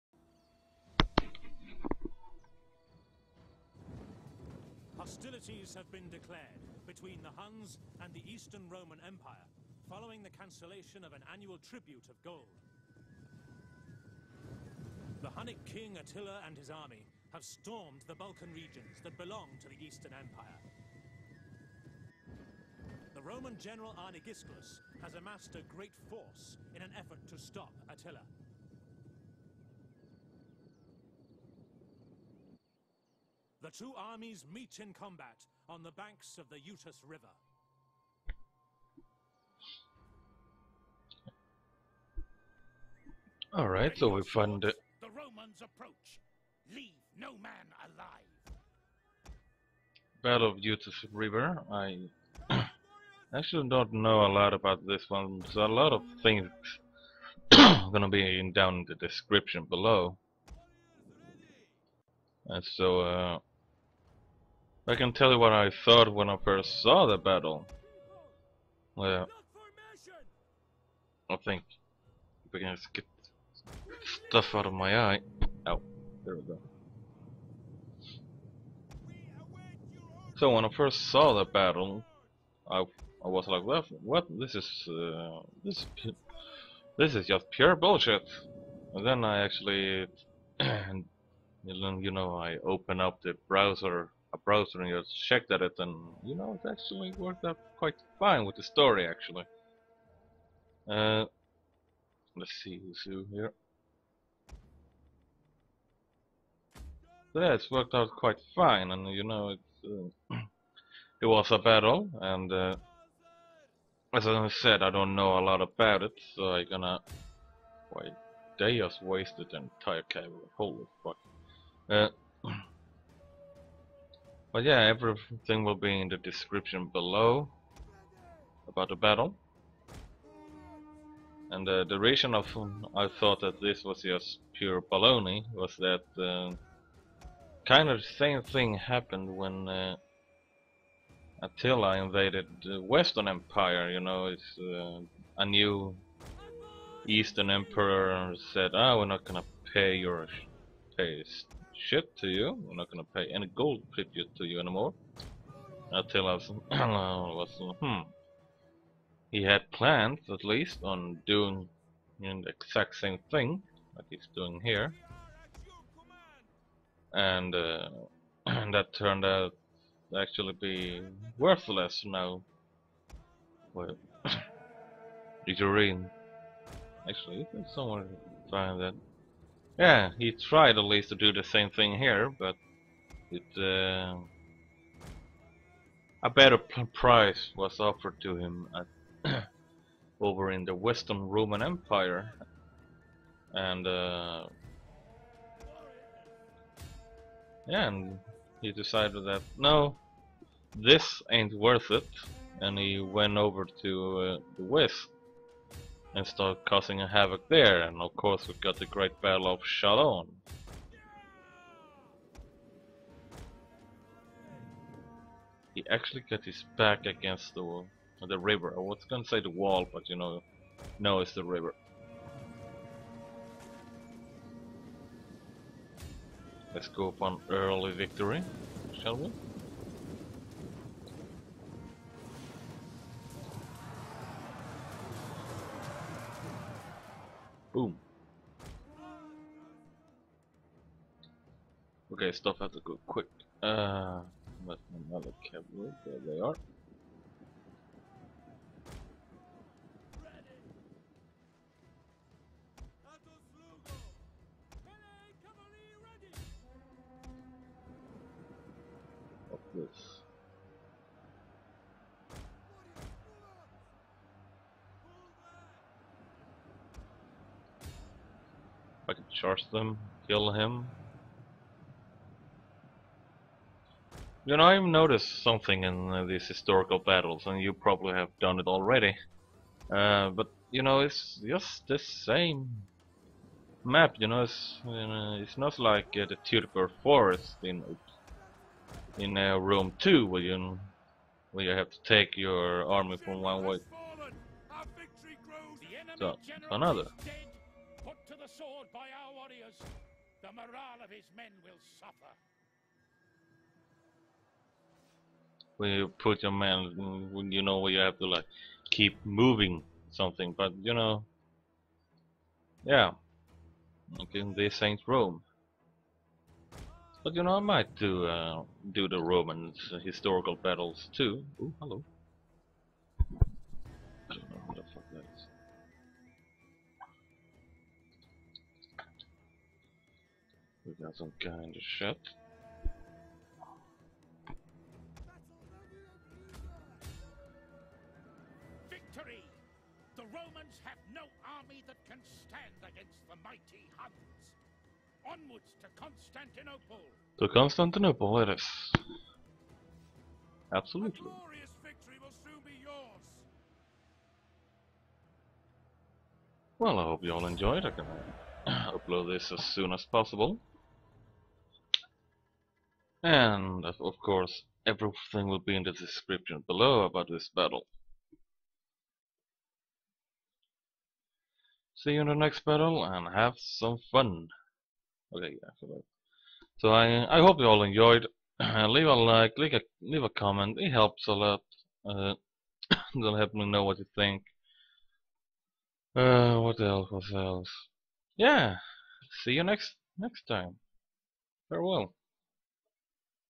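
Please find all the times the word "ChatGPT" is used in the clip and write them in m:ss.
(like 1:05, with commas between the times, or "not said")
not said.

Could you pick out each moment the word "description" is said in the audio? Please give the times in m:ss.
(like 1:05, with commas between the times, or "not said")
0:58, 2:06, 6:05.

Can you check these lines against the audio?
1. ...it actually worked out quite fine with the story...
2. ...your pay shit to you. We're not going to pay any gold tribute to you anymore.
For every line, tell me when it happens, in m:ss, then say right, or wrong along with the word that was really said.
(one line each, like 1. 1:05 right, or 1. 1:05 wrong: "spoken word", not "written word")
1. 1:36 right
2. 2:29 right.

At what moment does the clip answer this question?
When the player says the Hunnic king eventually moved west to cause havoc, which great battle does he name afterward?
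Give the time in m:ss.
3:28.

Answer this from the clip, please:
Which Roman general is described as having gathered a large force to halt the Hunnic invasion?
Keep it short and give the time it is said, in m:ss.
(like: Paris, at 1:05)
Arnegisclus, at 0:23.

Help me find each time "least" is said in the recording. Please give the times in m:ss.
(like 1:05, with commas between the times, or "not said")
2:40, 3:00.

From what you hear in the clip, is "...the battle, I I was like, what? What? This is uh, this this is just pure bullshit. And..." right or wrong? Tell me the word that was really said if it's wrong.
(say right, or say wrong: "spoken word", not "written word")
right.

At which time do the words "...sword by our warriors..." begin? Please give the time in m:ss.
4:58.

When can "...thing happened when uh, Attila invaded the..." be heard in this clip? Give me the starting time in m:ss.
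2:18.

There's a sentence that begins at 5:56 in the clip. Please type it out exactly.
Well, I hope you all enjoyed.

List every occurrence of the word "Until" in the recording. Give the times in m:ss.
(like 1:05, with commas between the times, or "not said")
2:35.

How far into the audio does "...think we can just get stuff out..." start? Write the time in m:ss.
1:11.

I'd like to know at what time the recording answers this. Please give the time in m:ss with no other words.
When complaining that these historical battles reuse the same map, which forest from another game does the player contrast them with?
4:46.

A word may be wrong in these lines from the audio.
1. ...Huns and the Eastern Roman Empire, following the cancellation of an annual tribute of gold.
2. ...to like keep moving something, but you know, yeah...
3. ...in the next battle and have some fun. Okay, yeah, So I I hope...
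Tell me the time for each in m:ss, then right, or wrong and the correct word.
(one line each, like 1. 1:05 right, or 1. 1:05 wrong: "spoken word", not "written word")
1. 0:07 right
2. 5:08 right
3. 6:12 right.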